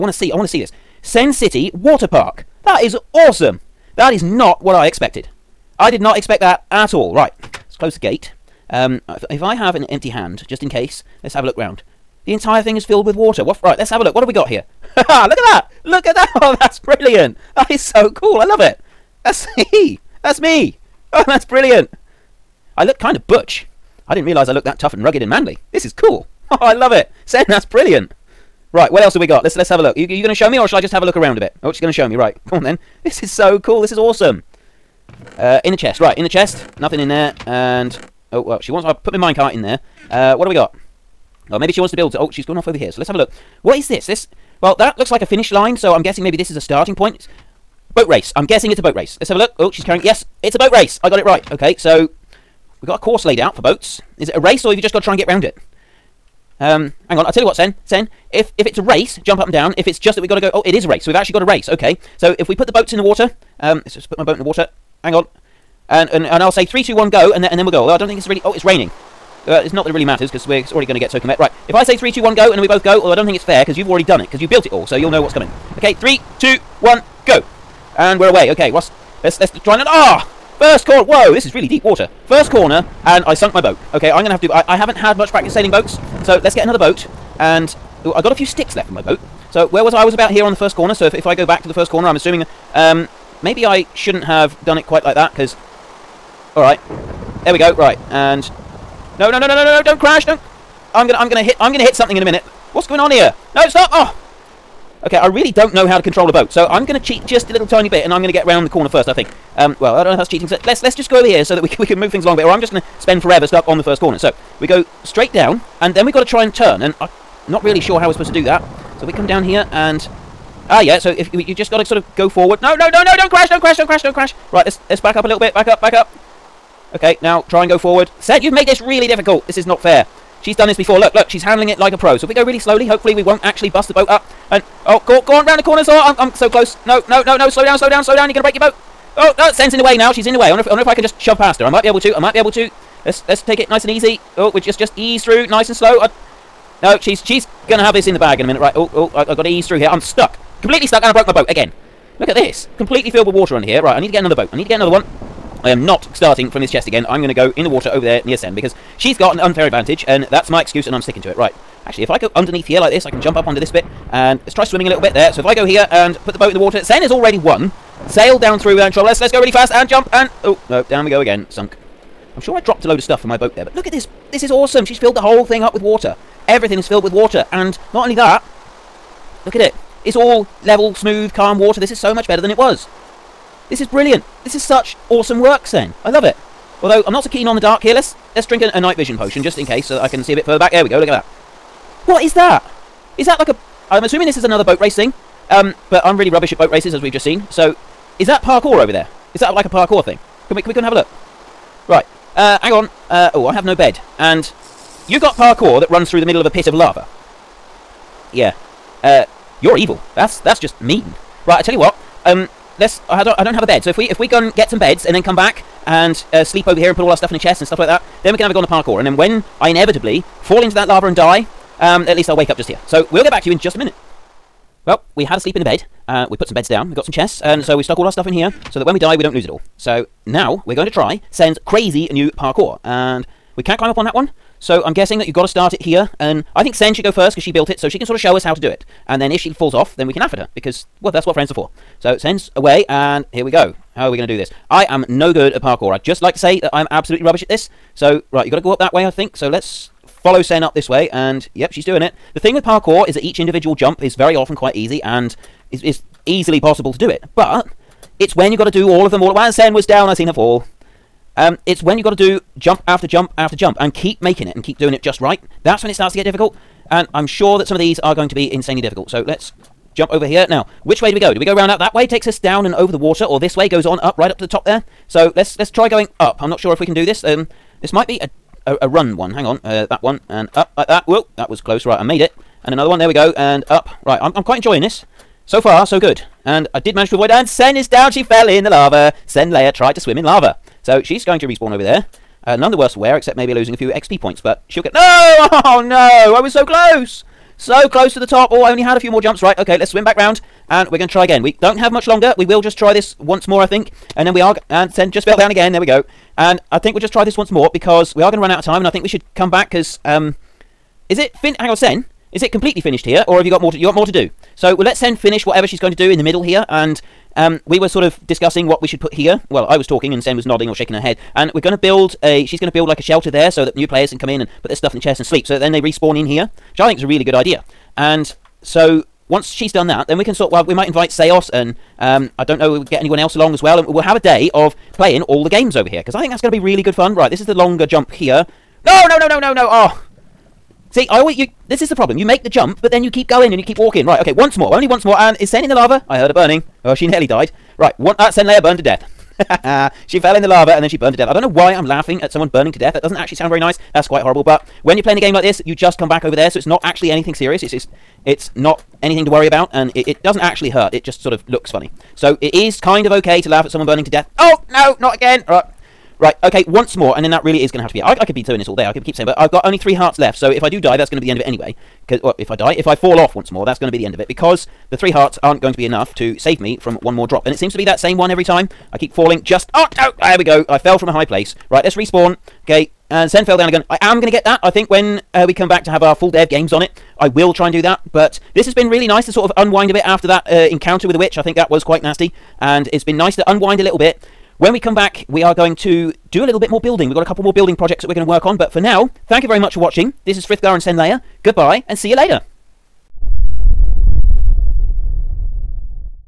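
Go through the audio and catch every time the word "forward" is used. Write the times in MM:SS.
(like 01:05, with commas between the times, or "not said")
02:02, 02:07.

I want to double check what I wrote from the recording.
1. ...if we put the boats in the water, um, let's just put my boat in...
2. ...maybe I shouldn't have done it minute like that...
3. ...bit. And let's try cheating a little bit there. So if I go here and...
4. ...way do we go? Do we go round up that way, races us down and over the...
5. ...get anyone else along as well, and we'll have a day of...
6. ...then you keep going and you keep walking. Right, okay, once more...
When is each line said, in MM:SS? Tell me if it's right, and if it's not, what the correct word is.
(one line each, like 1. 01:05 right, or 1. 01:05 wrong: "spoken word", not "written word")
1. 01:02 right
2. 01:33 wrong: "quite", not "minute"
3. 02:43 wrong: "swimming", not "cheating"
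4. 04:31 wrong: "takes", not "races"
5. 05:32 right
6. 05:42 right.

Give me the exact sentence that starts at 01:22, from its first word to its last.
First corner, and I sunk my boat.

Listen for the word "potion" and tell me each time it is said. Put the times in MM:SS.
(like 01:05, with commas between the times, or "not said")
03:09.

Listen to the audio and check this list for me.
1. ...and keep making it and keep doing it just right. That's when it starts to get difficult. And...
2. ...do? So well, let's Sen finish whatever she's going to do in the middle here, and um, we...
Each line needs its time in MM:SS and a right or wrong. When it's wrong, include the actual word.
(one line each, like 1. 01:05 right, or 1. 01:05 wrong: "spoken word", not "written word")
1. 04:23 right
2. 05:14 right.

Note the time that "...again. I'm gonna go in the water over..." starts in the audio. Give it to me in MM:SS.
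02:36.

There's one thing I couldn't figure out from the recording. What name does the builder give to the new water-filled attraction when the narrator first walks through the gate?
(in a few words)
Sen City Water Park.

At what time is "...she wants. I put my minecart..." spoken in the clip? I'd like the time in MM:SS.
00:38.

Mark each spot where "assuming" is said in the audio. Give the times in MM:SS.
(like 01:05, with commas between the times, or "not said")
01:32, 03:14.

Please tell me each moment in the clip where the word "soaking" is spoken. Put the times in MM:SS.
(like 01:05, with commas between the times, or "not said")
01:11.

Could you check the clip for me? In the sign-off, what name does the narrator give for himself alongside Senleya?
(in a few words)
Frithgar.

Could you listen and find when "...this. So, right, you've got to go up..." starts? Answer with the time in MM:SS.
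04:07.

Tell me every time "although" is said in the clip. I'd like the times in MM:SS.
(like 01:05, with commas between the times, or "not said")
01:07, 01:12, 03:06.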